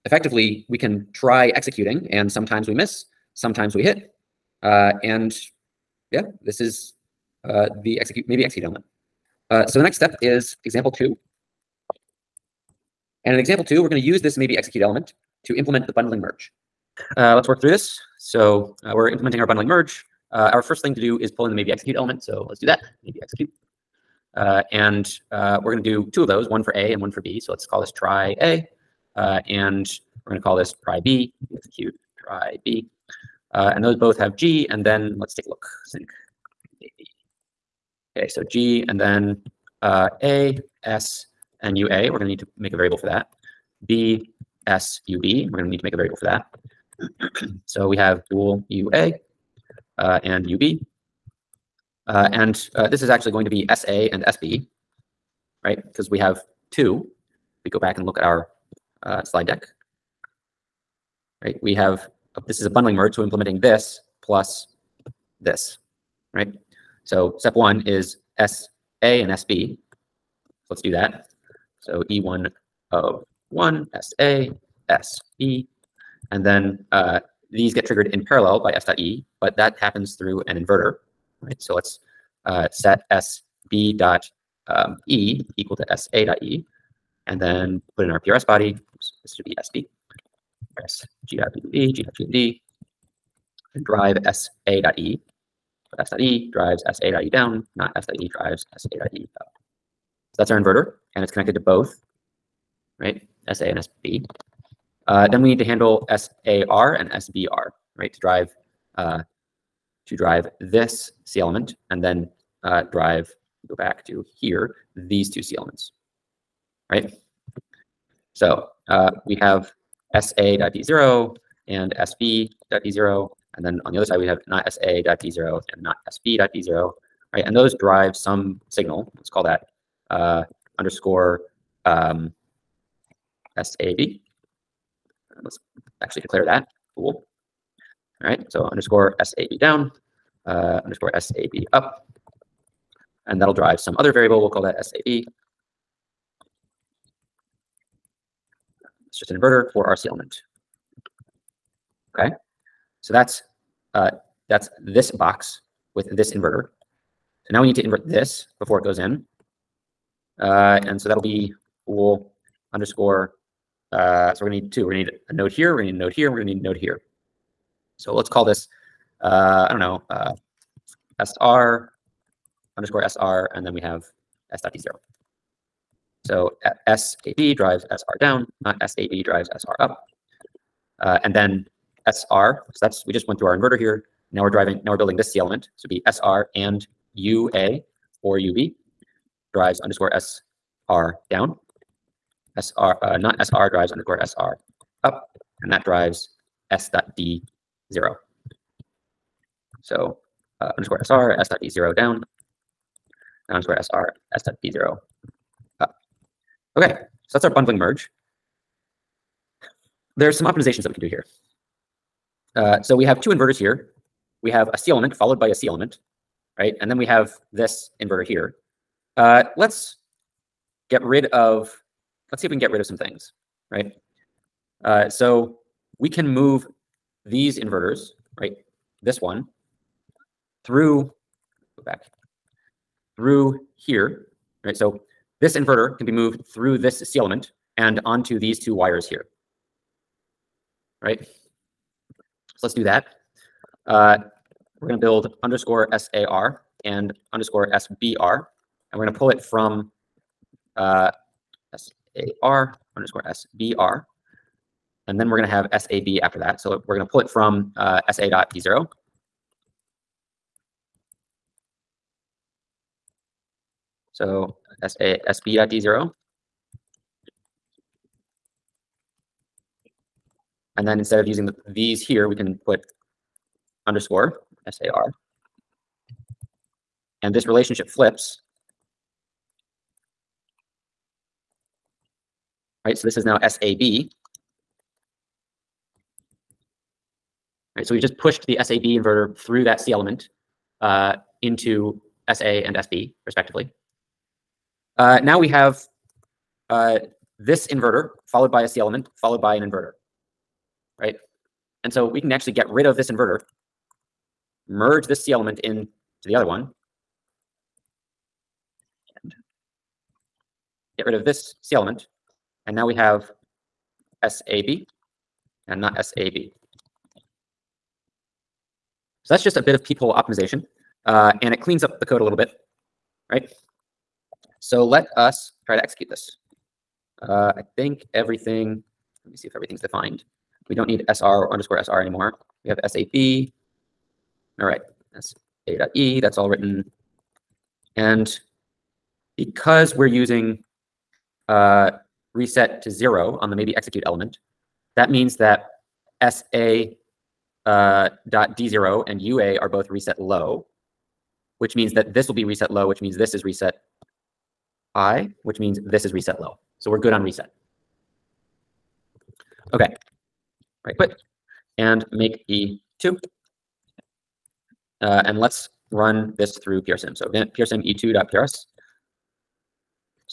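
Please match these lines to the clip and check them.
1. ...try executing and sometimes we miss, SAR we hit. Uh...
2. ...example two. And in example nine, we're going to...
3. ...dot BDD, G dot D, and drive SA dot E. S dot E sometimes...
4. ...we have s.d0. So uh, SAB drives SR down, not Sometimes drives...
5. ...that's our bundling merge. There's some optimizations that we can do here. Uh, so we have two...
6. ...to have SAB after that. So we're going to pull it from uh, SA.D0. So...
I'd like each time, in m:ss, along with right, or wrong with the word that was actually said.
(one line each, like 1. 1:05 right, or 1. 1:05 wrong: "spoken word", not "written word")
1. 0:01 wrong: "Sometimes", not "SAR"
2. 0:10 wrong: "two", not "nine"
3. 1:31 wrong: "drives", not "sometimes"
4. 2:53 wrong: "SAB", not "Sometimes"
5. 3:27 right
6. 4:15 right.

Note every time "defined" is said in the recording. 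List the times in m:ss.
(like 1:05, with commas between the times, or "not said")
5:29.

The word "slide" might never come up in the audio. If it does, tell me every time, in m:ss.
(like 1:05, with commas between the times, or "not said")
0:59.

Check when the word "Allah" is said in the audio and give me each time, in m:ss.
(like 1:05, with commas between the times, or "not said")
not said.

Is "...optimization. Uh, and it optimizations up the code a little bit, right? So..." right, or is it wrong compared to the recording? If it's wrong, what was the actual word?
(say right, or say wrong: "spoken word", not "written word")
wrong: "cleans", not "optimizations".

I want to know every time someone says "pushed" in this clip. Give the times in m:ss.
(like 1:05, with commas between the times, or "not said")
4:48.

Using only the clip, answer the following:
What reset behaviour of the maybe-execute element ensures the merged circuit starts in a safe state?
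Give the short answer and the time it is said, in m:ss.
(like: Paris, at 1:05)
reset to zero, at 5:42.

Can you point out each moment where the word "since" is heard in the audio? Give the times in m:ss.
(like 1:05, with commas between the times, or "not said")
not said.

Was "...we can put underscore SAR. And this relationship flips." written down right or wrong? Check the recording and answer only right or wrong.
right.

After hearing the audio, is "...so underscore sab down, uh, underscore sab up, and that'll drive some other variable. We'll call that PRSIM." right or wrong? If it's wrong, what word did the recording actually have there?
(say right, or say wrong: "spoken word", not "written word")
wrong: "SAV", not "PRSIM".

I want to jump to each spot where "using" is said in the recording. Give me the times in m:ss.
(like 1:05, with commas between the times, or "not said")
4:31, 5:40.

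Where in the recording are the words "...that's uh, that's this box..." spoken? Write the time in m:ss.
2:33.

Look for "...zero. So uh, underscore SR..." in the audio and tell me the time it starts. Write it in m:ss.
3:17.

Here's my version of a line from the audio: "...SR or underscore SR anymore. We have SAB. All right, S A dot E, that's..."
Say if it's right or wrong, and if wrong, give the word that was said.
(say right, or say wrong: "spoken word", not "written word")
right.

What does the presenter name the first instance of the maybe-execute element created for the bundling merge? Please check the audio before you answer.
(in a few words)
try A.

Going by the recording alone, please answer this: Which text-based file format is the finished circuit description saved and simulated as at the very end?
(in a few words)
PRS.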